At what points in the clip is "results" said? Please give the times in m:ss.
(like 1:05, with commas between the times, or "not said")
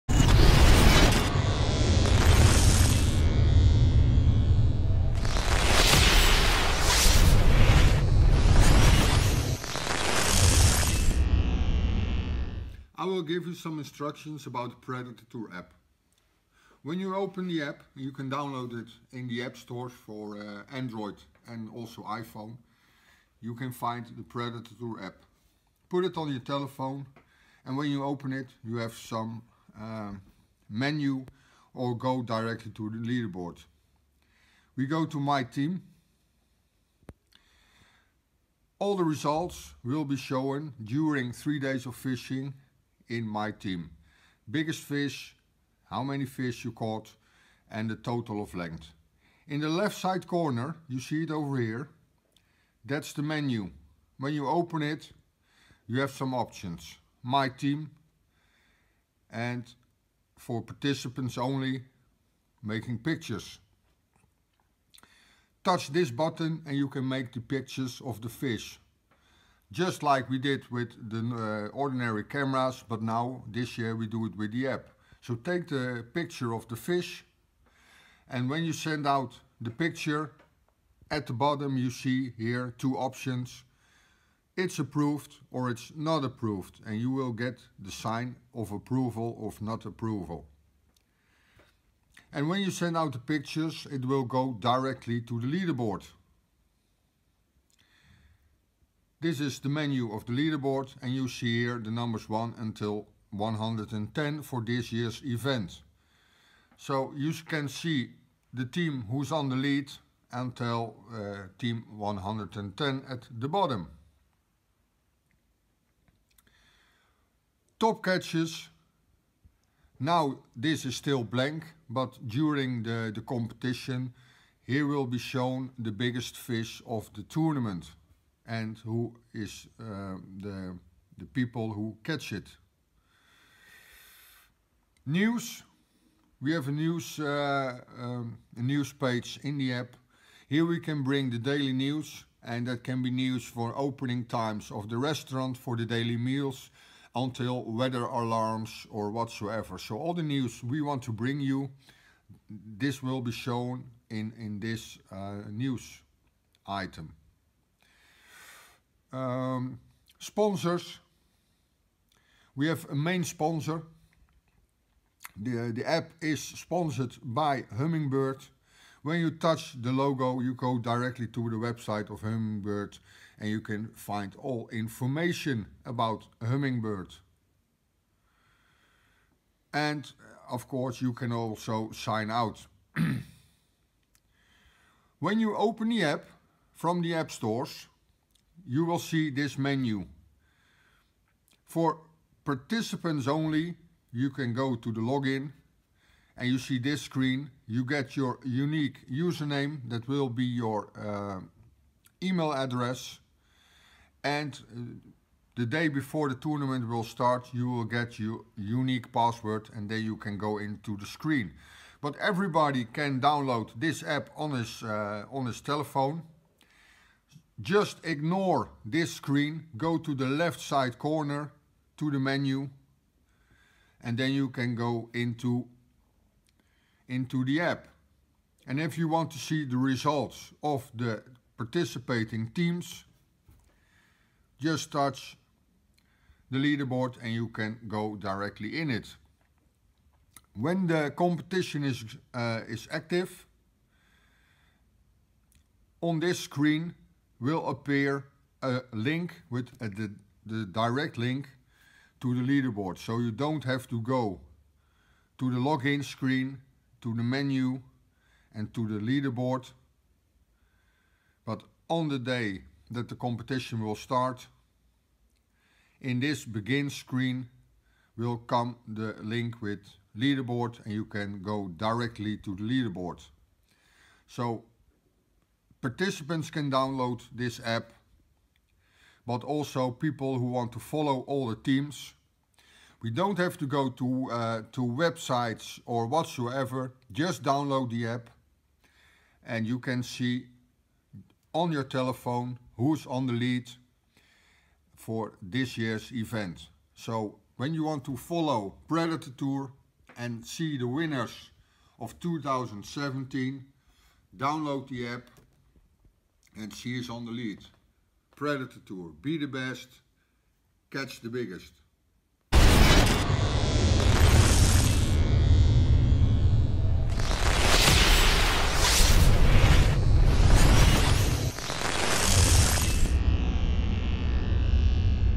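0:39, 3:49.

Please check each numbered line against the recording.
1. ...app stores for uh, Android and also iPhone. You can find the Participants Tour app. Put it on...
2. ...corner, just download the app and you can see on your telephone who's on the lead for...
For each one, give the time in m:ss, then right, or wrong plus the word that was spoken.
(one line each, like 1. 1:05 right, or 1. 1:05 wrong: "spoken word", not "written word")
1. 0:19 wrong: "Predator", not "Participants"
2. 4:46 wrong: "whatsoever", not "corner".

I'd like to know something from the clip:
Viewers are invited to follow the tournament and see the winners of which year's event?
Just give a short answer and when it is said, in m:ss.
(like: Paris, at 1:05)
2017, at 5:02.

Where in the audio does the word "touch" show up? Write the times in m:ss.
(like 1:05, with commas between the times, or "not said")
1:05, 2:49, 3:54.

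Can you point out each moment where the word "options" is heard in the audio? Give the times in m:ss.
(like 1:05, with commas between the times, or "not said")
0:56, 1:22.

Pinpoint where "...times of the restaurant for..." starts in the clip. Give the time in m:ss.
2:24.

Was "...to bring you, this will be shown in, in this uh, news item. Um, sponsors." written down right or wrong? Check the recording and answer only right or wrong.
right.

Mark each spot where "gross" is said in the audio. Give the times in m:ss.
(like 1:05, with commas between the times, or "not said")
not said.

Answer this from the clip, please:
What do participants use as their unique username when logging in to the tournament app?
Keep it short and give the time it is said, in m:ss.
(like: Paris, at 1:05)
Email address, at 3:22.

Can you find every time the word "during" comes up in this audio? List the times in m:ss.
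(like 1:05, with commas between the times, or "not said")
0:40, 2:02.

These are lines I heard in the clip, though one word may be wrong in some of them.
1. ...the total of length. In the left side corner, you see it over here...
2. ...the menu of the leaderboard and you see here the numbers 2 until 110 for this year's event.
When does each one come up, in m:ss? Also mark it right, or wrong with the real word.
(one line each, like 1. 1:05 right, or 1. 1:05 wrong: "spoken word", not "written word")
1. 0:47 right
2. 1:39 wrong: "1", not "2".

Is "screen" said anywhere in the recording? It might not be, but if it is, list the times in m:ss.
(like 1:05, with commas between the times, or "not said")
3:17, 3:31, 3:39, 4:06, 4:16, 4:26.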